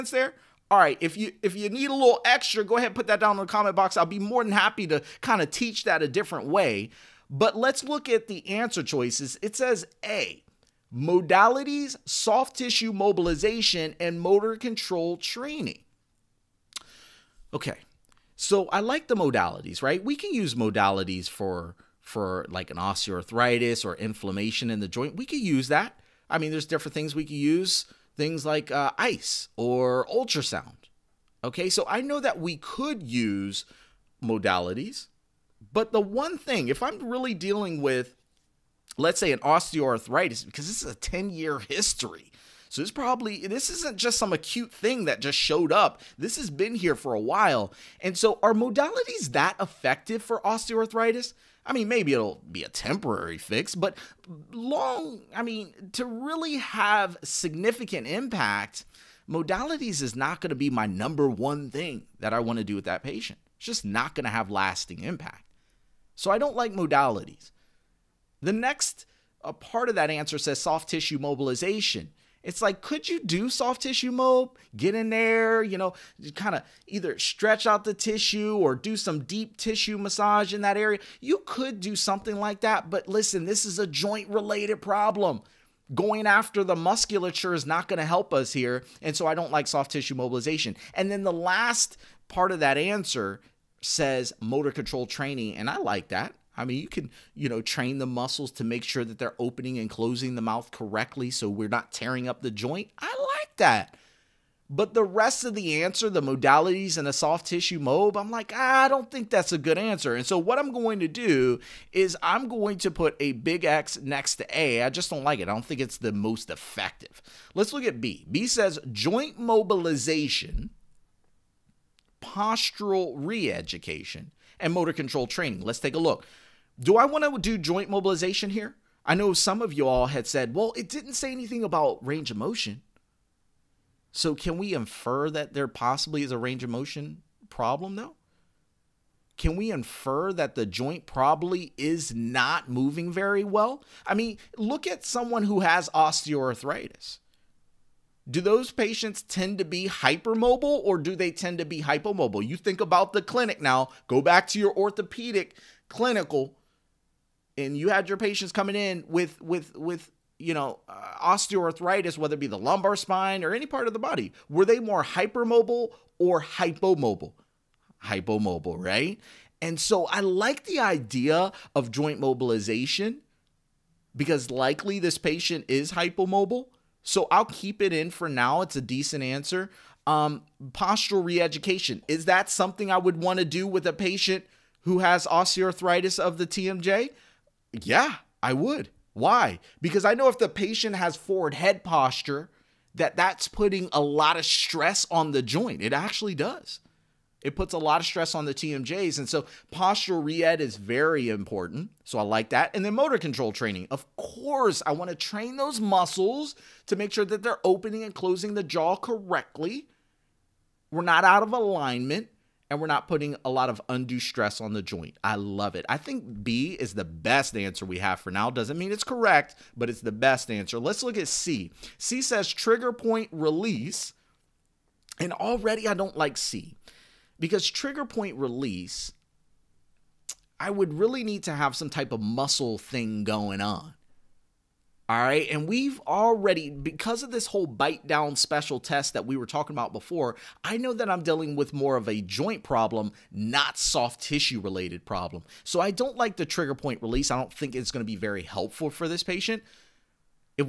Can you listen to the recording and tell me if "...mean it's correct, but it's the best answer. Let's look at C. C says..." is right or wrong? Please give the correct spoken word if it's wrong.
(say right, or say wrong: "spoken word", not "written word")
right.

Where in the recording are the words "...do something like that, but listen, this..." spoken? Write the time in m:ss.
1:21.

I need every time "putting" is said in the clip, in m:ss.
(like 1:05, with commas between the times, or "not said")
3:13, 3:33.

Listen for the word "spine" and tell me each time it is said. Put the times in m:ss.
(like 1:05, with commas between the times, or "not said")
2:42.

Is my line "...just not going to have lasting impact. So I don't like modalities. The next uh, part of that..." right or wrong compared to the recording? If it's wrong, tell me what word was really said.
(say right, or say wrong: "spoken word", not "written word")
right.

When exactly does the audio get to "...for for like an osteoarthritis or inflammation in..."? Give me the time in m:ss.
0:21.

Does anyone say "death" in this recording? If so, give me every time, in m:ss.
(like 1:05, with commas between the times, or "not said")
not said.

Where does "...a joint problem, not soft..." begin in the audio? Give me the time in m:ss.
4:02.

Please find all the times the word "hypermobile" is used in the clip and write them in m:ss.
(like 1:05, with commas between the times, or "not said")
2:29, 2:45.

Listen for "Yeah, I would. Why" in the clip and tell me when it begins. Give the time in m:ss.
3:07.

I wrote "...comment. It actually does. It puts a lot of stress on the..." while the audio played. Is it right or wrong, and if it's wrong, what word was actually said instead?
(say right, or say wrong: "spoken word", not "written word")
wrong: "joint", not "comment".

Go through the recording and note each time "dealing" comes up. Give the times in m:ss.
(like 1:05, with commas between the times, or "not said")
0:37, 4:01.